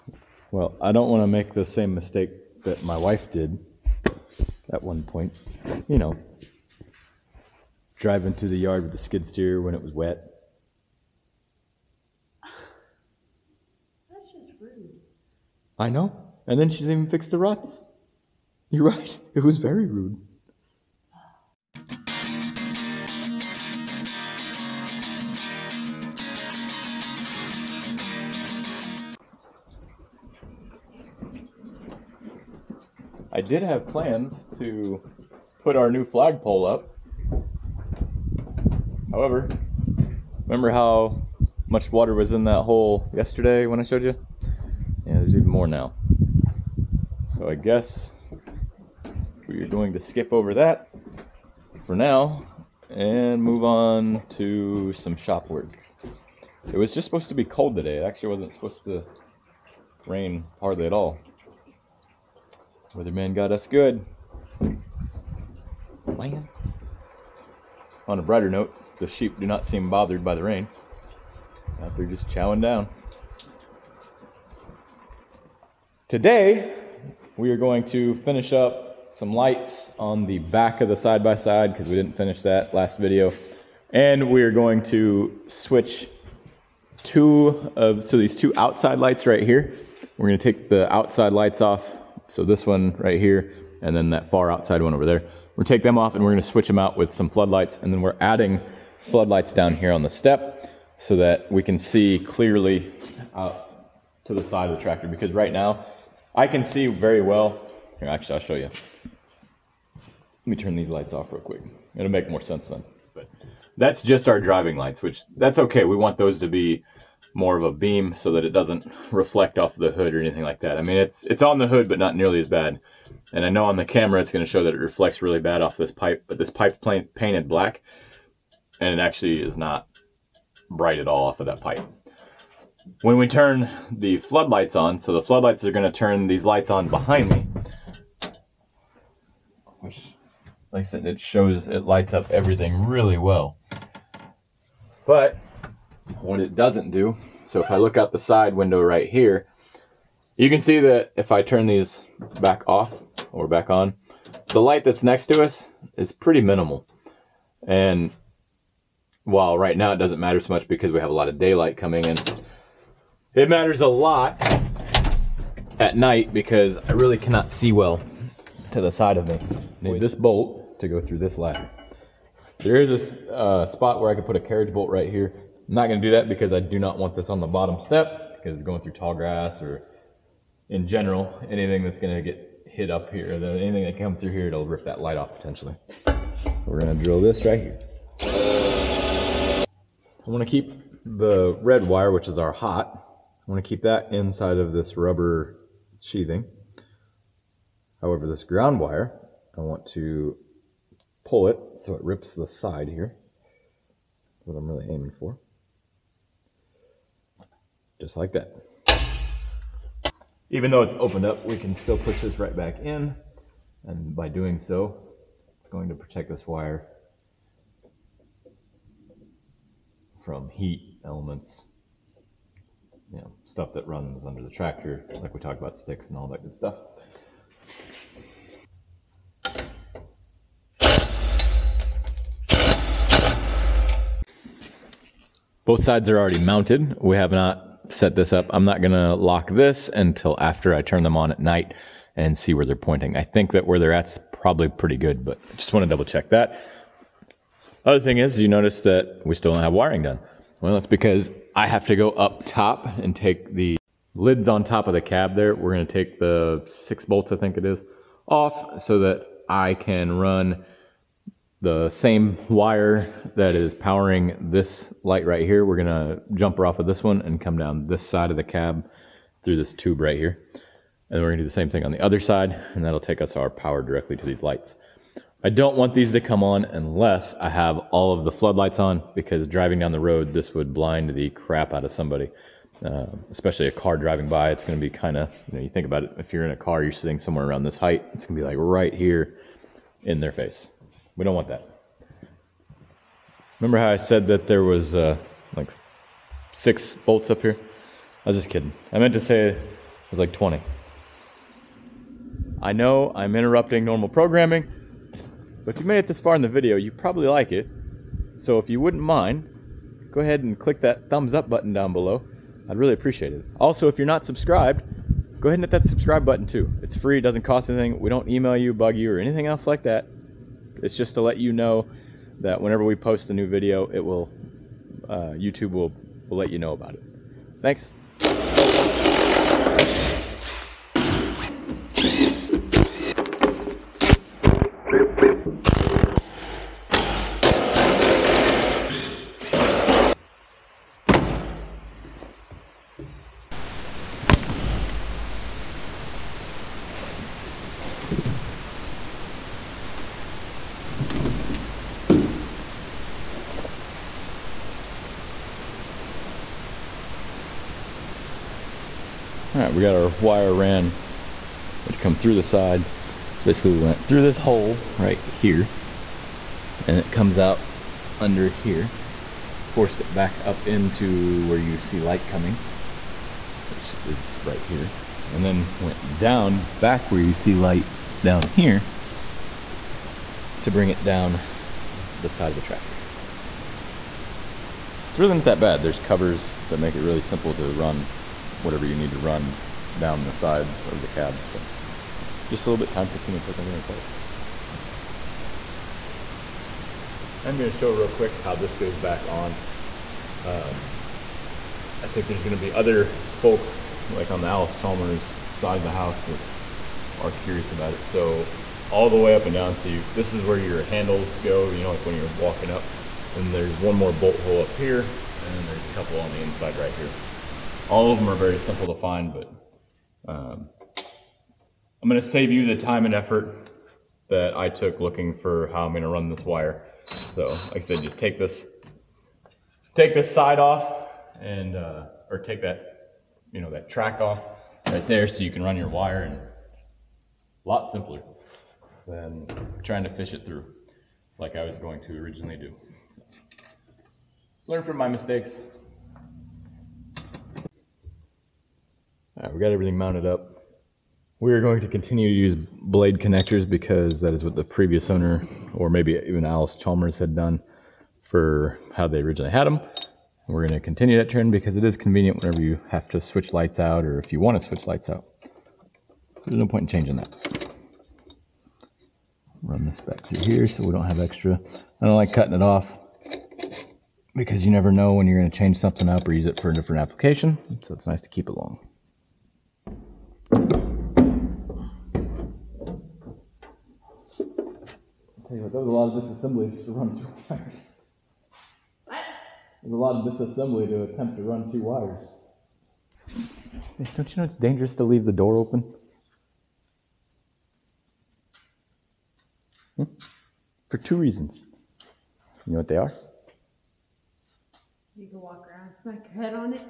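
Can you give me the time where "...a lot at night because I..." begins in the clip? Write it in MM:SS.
02:43.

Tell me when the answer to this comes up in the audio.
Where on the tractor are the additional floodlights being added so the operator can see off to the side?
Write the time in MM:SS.
01:39.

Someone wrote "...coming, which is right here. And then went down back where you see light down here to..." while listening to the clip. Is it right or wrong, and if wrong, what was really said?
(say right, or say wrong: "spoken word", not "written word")
right.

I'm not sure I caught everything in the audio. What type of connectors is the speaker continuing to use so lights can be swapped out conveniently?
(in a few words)
Blade connectors.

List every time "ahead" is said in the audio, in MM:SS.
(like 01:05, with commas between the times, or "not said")
05:10, 05:15.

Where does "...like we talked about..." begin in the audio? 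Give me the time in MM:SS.
03:45.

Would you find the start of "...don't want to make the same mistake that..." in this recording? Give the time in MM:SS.
00:00.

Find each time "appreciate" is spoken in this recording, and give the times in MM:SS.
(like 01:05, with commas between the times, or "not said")
05:12.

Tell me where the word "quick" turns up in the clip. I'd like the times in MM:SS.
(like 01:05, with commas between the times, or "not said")
01:51, 06:38.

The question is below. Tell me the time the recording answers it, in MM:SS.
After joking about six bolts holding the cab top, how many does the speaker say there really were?
05:00.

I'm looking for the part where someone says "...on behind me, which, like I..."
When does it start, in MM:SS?
02:16.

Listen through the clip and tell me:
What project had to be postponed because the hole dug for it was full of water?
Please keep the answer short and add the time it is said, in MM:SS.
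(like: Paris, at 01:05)
New flagpole, at 00:35.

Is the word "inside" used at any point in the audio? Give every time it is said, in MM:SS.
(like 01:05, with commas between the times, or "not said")
03:14, 06:56.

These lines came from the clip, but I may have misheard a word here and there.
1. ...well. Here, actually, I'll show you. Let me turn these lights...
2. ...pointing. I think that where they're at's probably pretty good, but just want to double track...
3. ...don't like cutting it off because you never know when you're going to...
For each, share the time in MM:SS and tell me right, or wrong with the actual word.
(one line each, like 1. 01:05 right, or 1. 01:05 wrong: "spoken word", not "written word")
1. 01:47 right
2. 04:02 wrong: "check", not "track"
3. 07:52 right.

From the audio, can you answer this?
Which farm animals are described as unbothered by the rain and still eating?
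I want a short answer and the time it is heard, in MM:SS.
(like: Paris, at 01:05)
Sheep, at 01:09.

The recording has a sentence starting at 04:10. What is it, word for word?
Well, that's because I have to go up top and take the lids on top of the cab there.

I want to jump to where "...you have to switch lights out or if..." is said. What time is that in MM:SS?
07:42.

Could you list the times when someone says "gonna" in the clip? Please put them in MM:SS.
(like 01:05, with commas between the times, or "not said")
01:30, 01:36, 04:25, 04:31.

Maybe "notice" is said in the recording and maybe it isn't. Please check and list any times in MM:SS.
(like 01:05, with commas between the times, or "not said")
04:08.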